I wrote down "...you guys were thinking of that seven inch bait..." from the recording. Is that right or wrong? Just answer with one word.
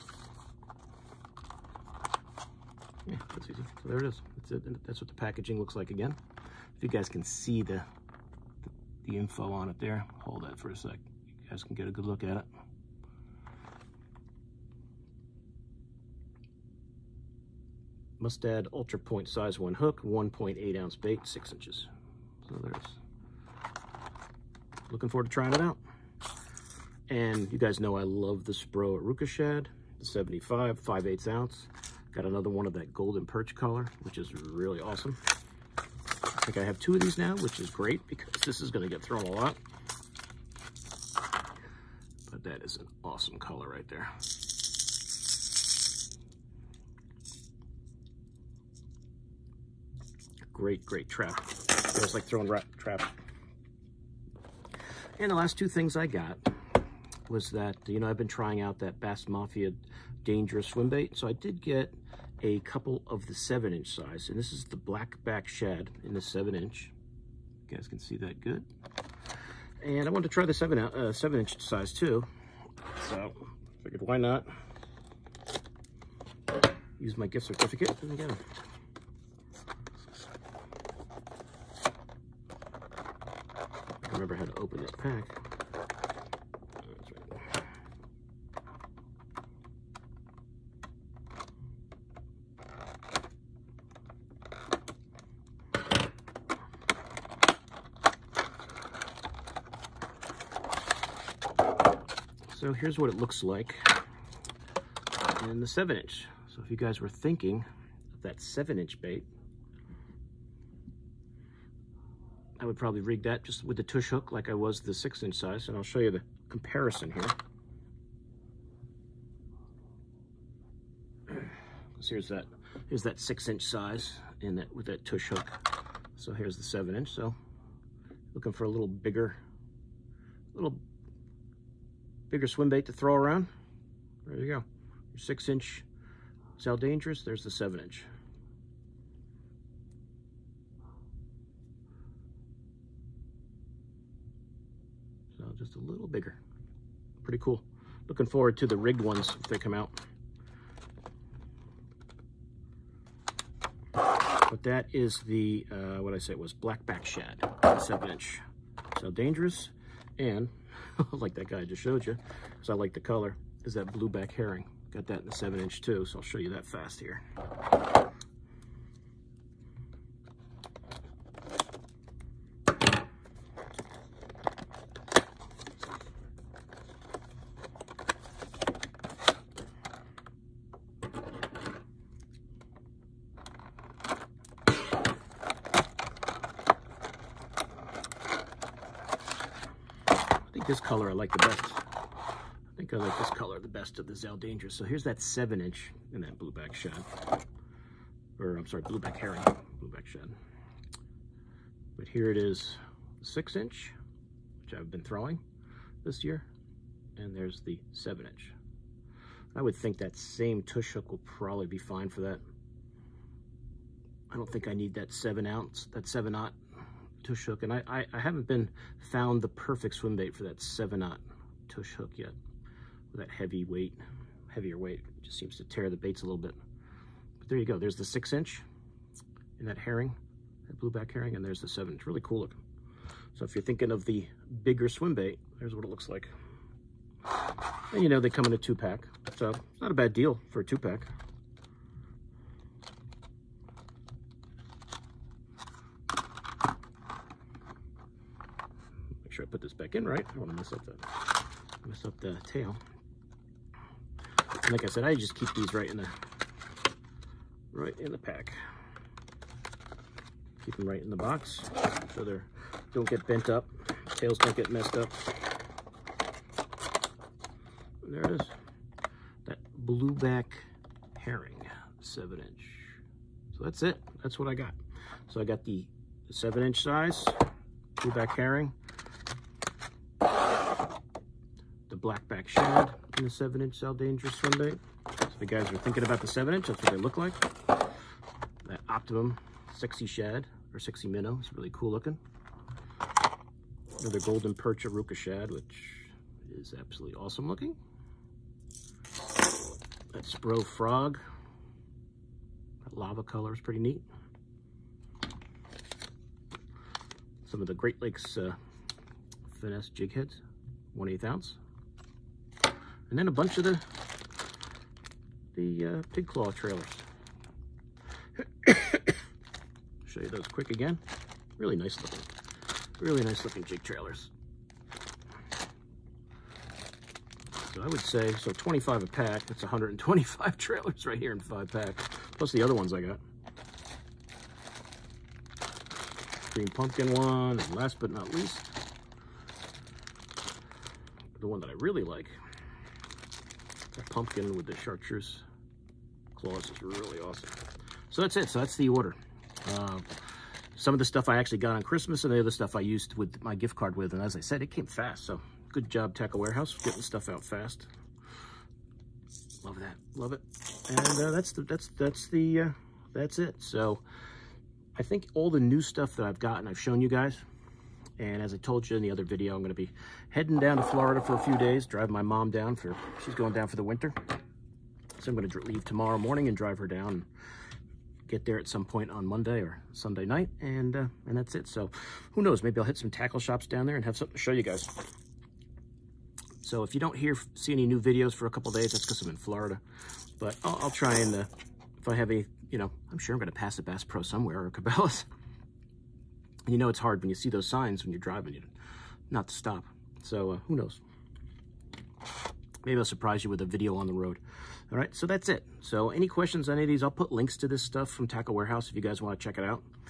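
right.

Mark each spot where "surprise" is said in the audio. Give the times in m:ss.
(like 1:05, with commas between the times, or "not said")
6:43.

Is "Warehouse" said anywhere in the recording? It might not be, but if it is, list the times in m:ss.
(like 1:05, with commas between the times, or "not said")
5:56, 6:48.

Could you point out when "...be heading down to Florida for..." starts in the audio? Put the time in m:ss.
6:09.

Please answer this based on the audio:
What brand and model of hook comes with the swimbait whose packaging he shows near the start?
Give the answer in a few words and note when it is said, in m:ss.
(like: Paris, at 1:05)
Mustad Ultra Point, at 0:18.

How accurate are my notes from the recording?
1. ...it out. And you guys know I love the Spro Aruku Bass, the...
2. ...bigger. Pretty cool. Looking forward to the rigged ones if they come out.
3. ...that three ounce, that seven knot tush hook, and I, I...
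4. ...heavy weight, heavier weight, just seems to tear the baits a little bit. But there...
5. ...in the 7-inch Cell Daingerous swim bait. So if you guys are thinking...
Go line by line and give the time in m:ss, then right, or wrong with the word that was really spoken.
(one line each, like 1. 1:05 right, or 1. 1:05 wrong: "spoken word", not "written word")
1. 0:25 wrong: "Shad", not "Bass"
2. 2:26 right
3. 3:34 wrong: "seven", not "three"
4. 3:43 right
5. 4:43 right.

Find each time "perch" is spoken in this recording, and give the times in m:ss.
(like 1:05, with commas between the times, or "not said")
0:33, 4:54.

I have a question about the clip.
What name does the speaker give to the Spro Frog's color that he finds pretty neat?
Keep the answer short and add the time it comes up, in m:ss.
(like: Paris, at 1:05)
Lava, at 5:02.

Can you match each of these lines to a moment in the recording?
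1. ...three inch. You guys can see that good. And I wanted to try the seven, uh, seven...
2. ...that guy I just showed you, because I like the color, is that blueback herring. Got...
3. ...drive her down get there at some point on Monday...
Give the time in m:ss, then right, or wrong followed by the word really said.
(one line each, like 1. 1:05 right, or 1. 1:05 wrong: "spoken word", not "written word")
1. 1:06 wrong: "seven", not "three"
2. 2:41 right
3. 6:16 right.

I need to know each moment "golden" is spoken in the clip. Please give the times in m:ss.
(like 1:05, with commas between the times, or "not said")
0:32, 4:54.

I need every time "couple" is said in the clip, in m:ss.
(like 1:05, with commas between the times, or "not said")
1:02, 6:28.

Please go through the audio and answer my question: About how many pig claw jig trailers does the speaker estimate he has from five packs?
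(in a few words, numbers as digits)
125.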